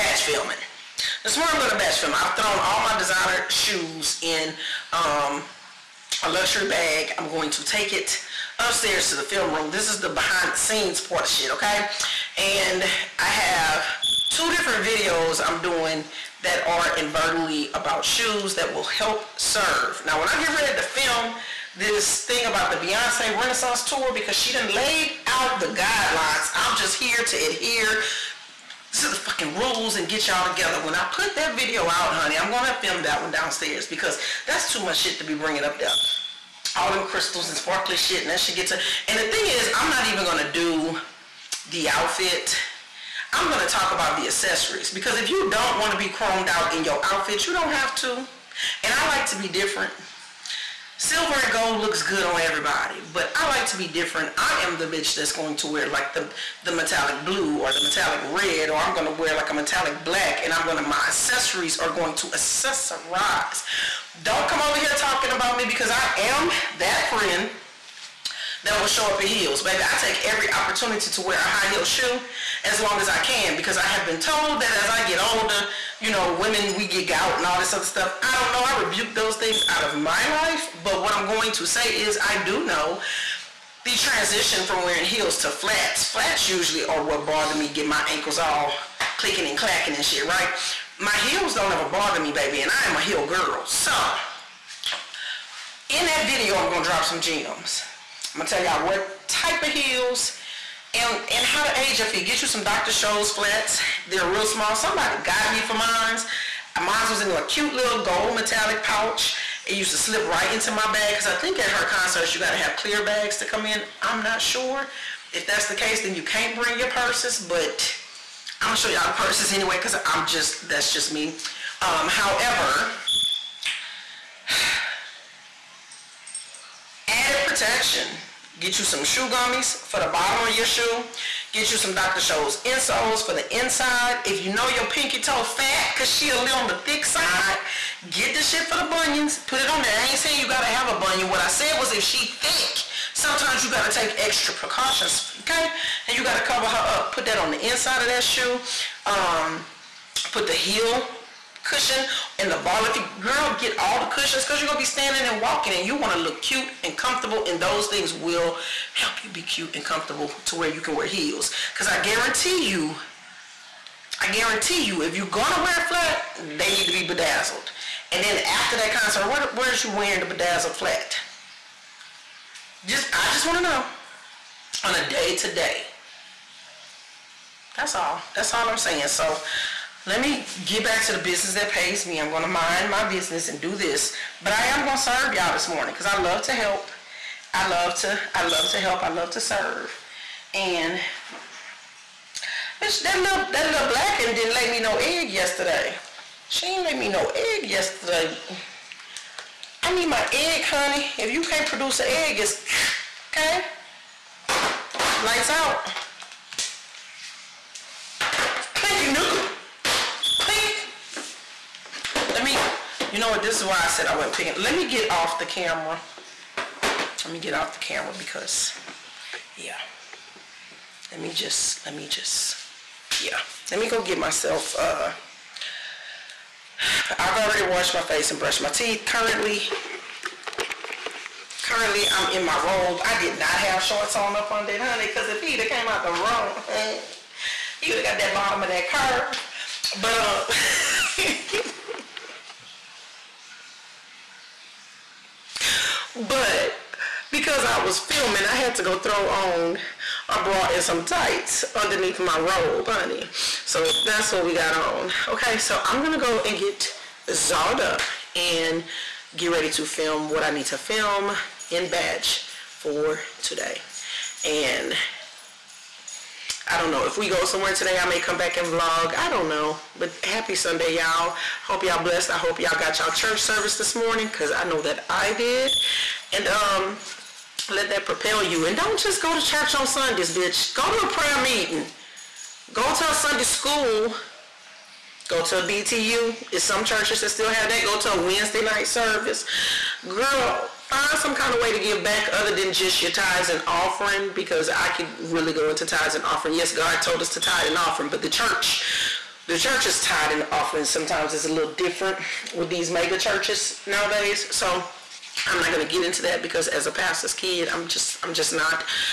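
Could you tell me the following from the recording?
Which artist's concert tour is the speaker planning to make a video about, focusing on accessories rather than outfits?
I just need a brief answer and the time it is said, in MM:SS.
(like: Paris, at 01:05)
Beyonce, at 00:22.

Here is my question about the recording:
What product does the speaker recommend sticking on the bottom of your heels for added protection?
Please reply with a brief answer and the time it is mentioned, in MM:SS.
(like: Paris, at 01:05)
shoe gummies, at 02:09.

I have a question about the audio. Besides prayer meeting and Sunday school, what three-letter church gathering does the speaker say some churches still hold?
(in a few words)
BTU.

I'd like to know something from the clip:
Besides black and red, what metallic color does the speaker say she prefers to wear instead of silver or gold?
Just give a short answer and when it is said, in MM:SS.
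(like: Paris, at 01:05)
blue, at 00:56.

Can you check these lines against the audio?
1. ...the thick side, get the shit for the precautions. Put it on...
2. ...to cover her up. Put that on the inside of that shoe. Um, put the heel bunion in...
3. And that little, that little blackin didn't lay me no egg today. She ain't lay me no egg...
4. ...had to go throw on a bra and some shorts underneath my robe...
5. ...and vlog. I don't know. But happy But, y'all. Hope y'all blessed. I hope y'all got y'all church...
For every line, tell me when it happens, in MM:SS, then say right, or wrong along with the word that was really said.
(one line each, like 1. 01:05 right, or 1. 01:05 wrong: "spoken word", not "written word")
1. 02:16 wrong: "bunions", not "precautions"
2. 02:26 wrong: "cushion", not "bunion"
3. 03:10 wrong: "yesterday", not "today"
4. 04:08 wrong: "tights", not "shorts"
5. 04:28 wrong: "Sunday", not "But".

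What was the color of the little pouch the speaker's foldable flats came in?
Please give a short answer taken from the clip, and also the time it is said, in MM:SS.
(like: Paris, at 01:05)
gold metallic, at 01:48.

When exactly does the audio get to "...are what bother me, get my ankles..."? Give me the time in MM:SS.
01:26.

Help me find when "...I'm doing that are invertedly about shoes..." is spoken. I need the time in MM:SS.
00:15.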